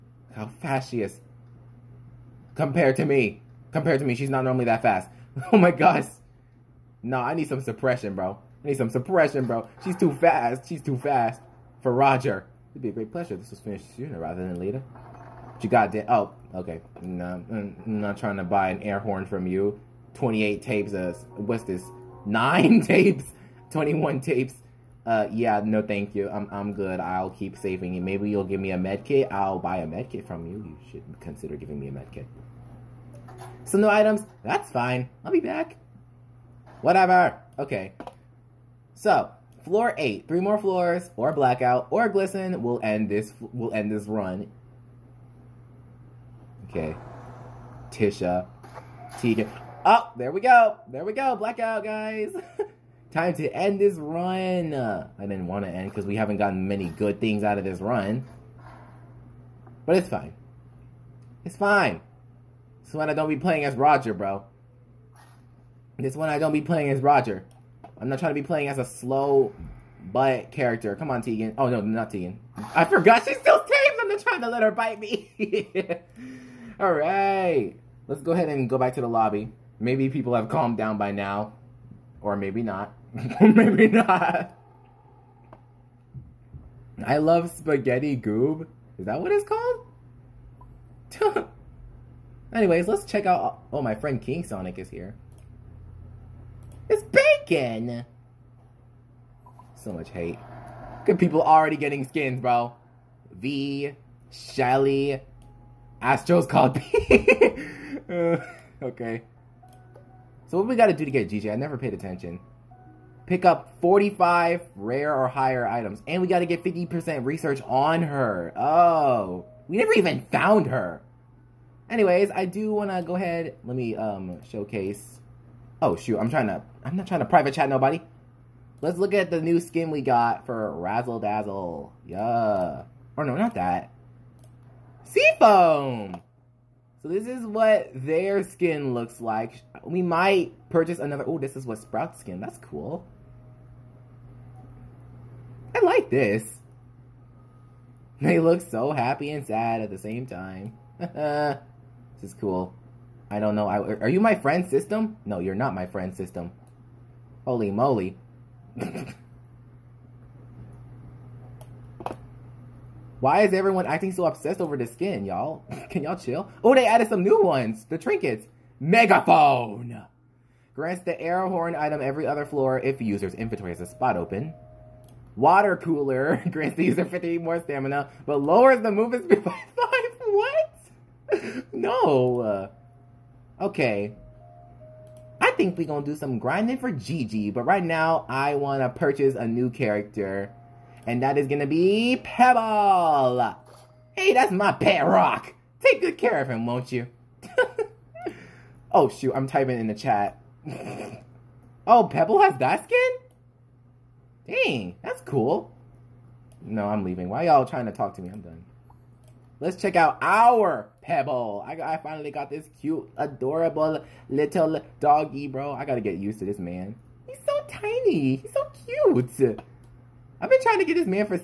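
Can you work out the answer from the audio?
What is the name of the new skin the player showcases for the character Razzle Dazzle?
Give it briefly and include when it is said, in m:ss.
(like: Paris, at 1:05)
Seafoam, at 2:15.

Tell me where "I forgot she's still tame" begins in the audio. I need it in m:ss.
1:12.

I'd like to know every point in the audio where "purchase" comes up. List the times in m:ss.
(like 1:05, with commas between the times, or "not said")
2:20, 3:08.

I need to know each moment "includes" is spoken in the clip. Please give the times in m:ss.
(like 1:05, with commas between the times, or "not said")
not said.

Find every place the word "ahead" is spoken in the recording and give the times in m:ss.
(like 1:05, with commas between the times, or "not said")
1:18, 2:03.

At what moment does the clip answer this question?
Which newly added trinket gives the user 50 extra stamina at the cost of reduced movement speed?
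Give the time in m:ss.
2:55.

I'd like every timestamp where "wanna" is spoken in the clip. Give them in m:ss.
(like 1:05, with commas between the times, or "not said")
2:02, 3:08.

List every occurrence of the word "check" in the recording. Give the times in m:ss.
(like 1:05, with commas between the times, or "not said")
1:33, 3:29.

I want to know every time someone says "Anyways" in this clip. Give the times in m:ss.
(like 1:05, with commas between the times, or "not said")
1:32, 2:01.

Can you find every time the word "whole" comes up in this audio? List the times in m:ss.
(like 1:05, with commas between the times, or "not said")
not said.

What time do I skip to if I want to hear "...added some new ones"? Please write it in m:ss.
2:46.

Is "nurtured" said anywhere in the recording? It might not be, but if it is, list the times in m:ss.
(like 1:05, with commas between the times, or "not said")
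not said.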